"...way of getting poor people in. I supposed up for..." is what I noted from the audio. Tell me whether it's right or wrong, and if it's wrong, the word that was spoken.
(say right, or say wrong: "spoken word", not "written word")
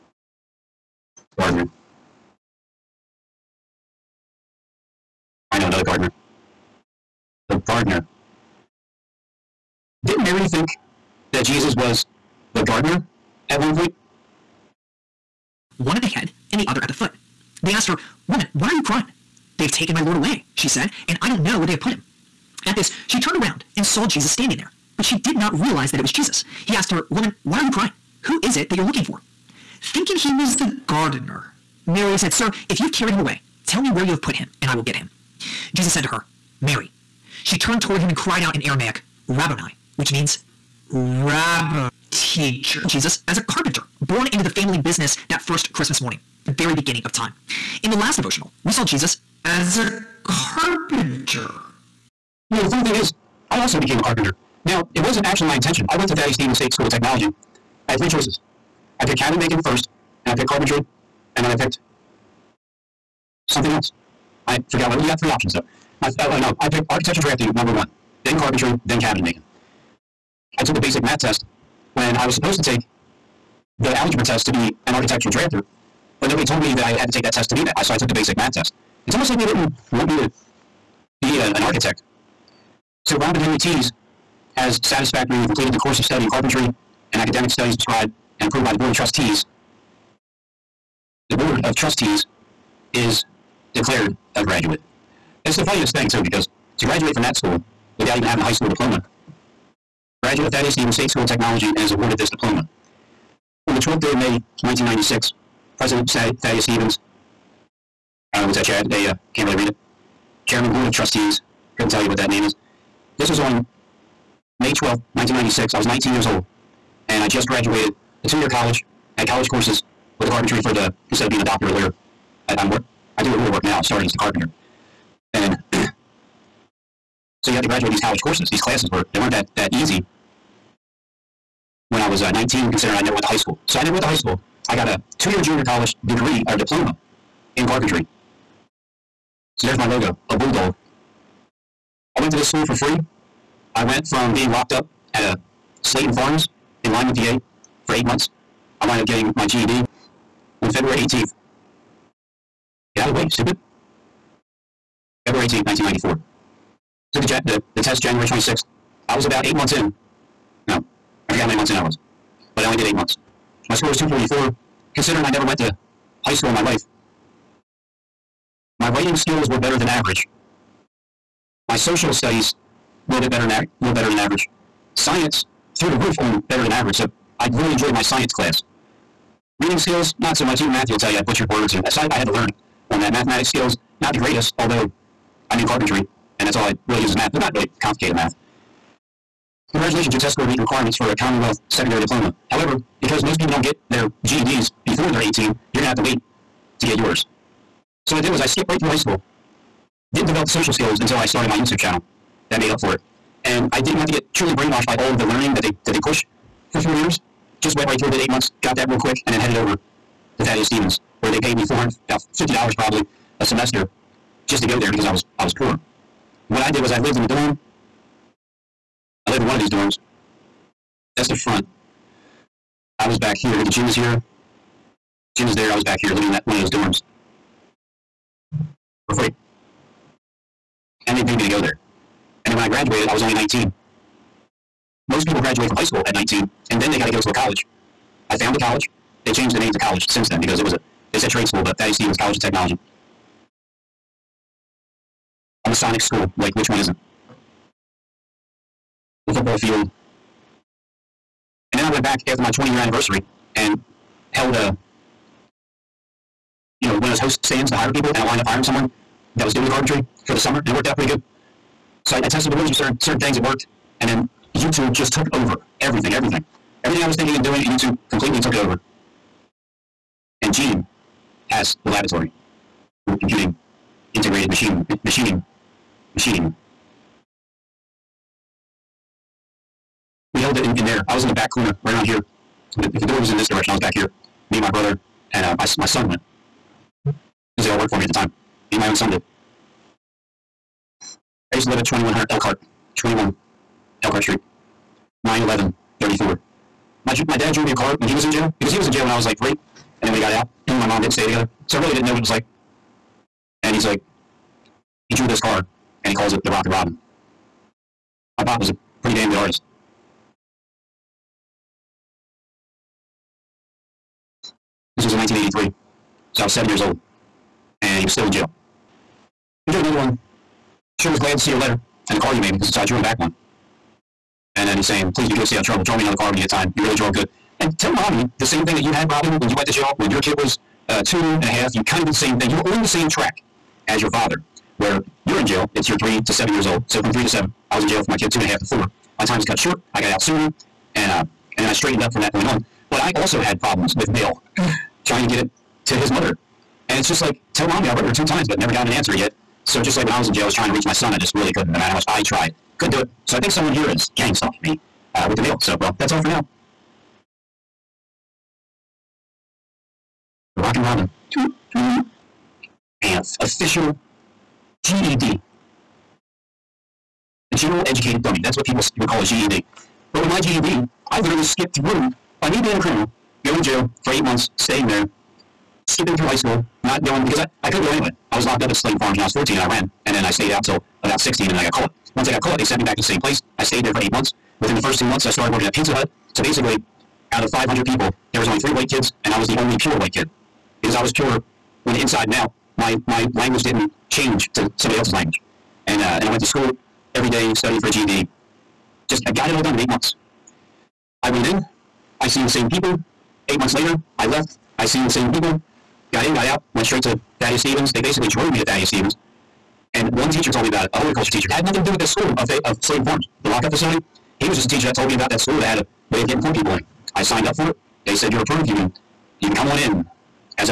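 wrong: "signed", not "supposed".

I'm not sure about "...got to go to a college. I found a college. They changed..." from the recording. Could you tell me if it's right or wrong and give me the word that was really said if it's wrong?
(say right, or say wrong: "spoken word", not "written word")
right.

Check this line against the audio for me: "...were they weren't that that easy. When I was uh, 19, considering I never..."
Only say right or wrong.
right.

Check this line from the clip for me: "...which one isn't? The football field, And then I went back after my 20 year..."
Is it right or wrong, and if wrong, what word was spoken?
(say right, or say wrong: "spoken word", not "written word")
right.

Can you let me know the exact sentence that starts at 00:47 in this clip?
In the last devotional, we saw Jesus as a carpenter.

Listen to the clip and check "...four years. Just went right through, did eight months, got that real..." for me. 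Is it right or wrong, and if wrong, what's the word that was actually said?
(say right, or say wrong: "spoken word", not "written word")
right.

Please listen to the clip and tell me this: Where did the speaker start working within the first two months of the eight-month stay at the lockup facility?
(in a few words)
Pizza Hut.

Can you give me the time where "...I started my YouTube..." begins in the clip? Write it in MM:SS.
03:21.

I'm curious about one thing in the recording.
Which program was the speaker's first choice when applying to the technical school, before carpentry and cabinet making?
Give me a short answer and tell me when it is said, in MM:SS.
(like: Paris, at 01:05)
architecture drafting, at 01:06.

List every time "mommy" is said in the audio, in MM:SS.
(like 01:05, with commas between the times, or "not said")
05:27, 05:47.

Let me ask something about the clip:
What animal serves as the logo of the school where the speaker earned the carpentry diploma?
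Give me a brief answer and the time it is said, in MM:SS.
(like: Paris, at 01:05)
bulldog, at 02:20.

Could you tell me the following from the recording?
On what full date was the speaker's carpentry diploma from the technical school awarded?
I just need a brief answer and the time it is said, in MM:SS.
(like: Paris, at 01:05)
May 12, 1996, at 01:54.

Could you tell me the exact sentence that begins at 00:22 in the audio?
At this, she turned around and saw Jesus standing there, but she did not realize that it was Jesus.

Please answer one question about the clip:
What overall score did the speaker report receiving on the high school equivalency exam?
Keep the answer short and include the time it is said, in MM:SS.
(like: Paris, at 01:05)
244, at 02:43.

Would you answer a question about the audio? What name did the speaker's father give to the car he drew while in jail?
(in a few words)
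Rock and Robin.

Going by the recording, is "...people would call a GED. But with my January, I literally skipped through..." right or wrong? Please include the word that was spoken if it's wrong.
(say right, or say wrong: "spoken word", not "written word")
wrong: "GED", not "January".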